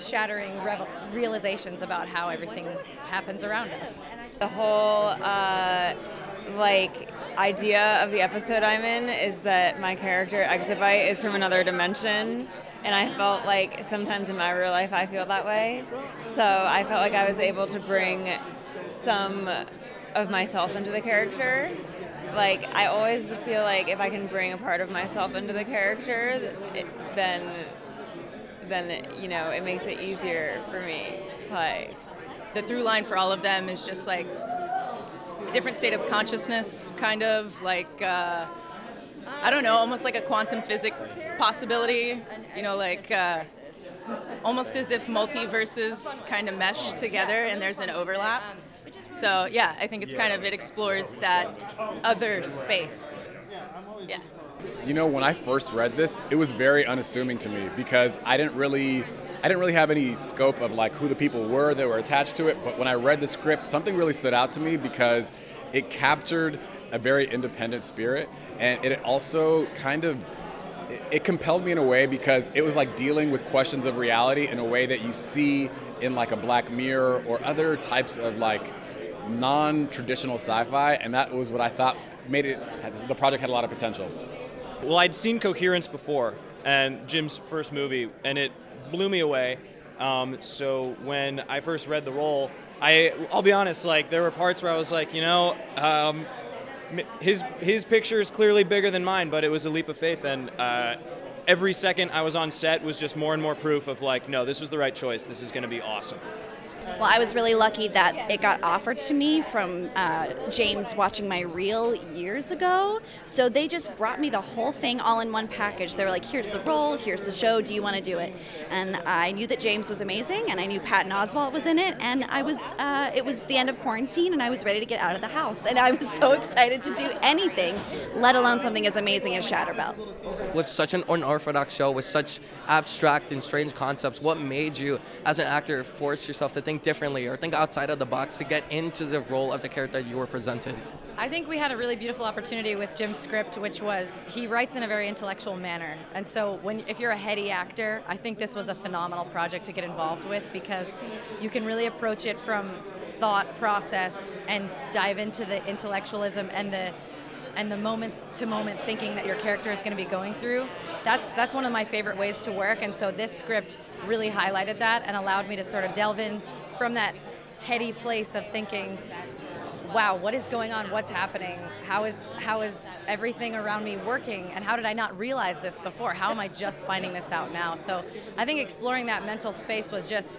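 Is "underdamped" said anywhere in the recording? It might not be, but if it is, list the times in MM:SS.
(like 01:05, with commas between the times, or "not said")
not said.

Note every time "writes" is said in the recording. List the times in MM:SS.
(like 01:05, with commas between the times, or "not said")
02:24.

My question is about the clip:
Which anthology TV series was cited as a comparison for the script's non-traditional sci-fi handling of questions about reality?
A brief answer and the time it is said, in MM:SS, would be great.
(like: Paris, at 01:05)
Black Mirror, at 01:16.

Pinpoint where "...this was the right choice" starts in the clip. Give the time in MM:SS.
01:44.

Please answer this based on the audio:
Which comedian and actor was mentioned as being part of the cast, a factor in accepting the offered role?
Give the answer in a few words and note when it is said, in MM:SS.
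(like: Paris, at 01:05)
Patton Oswalt, at 02:00.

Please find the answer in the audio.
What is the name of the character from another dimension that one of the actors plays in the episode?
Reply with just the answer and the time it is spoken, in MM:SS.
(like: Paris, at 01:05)
Exabyte, at 00:10.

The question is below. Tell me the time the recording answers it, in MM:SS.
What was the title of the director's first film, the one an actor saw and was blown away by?
01:25.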